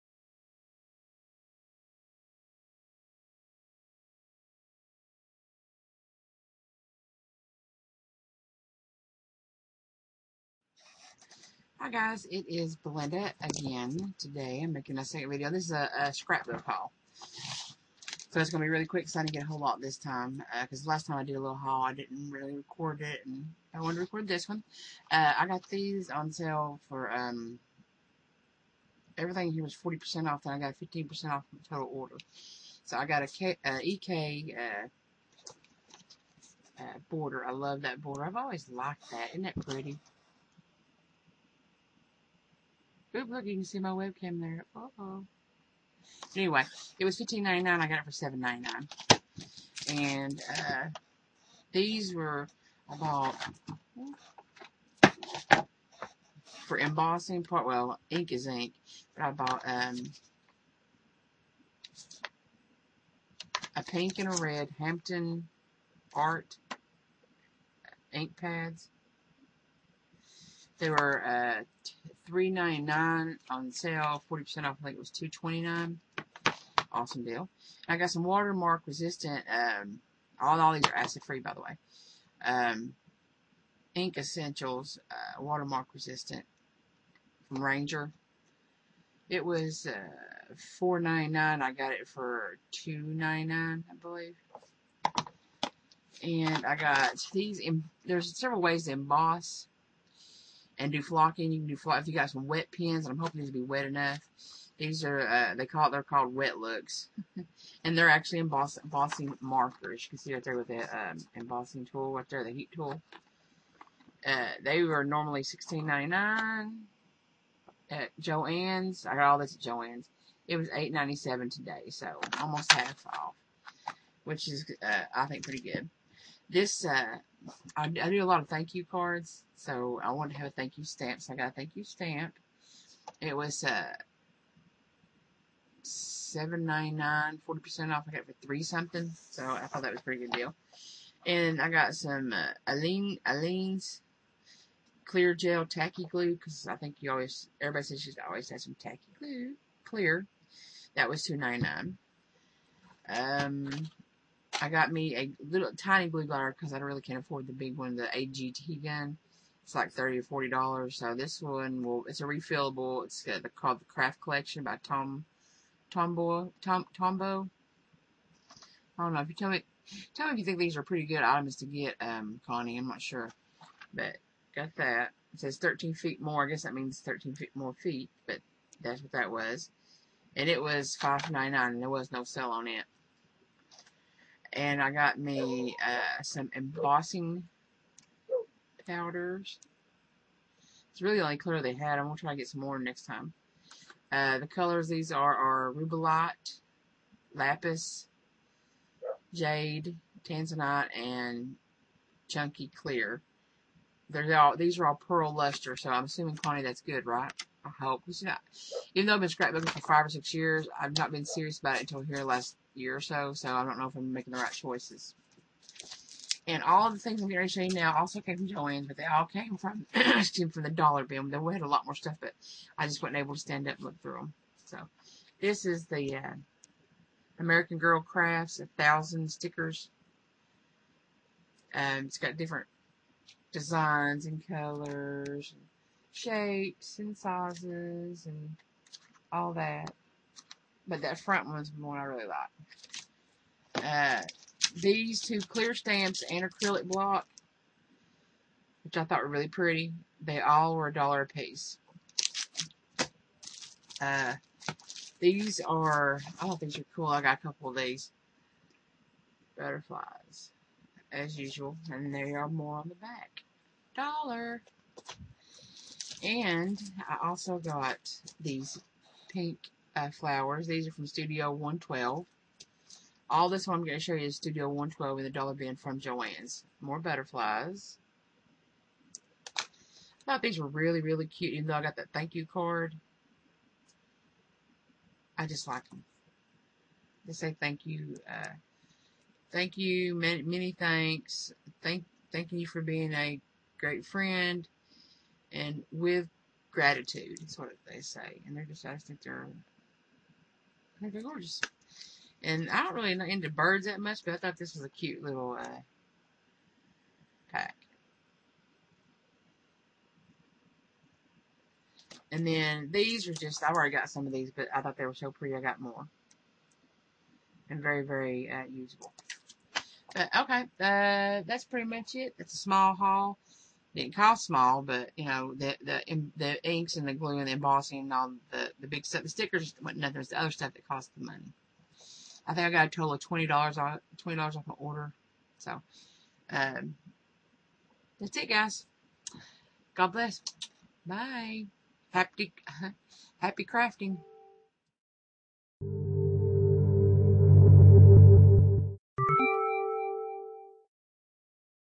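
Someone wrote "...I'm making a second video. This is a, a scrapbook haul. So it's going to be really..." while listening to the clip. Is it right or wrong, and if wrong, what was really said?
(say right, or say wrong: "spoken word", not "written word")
right.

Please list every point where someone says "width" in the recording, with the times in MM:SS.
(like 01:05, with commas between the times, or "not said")
not said.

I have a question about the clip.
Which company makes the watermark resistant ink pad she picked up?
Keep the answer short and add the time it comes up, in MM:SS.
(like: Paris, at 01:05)
Ranger, at 01:27.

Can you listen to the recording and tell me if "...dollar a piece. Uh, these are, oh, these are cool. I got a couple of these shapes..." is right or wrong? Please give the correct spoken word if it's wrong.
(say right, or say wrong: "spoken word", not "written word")
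wrong: "butterflies", not "shapes".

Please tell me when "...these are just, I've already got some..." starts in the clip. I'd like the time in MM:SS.
05:12.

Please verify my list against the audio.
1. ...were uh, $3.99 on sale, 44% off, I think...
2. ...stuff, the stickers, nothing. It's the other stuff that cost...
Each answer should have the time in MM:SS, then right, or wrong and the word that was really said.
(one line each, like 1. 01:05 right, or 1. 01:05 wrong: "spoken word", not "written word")
1. 01:10 wrong: "40", not "44"
2. 05:29 right.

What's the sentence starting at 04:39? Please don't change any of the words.
I thought these were really, really cute, even though I got that thank you card.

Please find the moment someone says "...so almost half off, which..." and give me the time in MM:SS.
02:01.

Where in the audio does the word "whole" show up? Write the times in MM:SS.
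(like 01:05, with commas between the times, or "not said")
00:19.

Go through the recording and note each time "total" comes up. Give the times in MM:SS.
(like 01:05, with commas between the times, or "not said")
00:31, 05:32.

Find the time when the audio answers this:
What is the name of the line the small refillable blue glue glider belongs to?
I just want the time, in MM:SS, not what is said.
02:43.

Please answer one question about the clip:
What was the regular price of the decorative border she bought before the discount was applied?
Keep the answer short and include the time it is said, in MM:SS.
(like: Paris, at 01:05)
$15.99, at 00:47.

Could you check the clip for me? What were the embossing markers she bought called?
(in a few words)
wet looks.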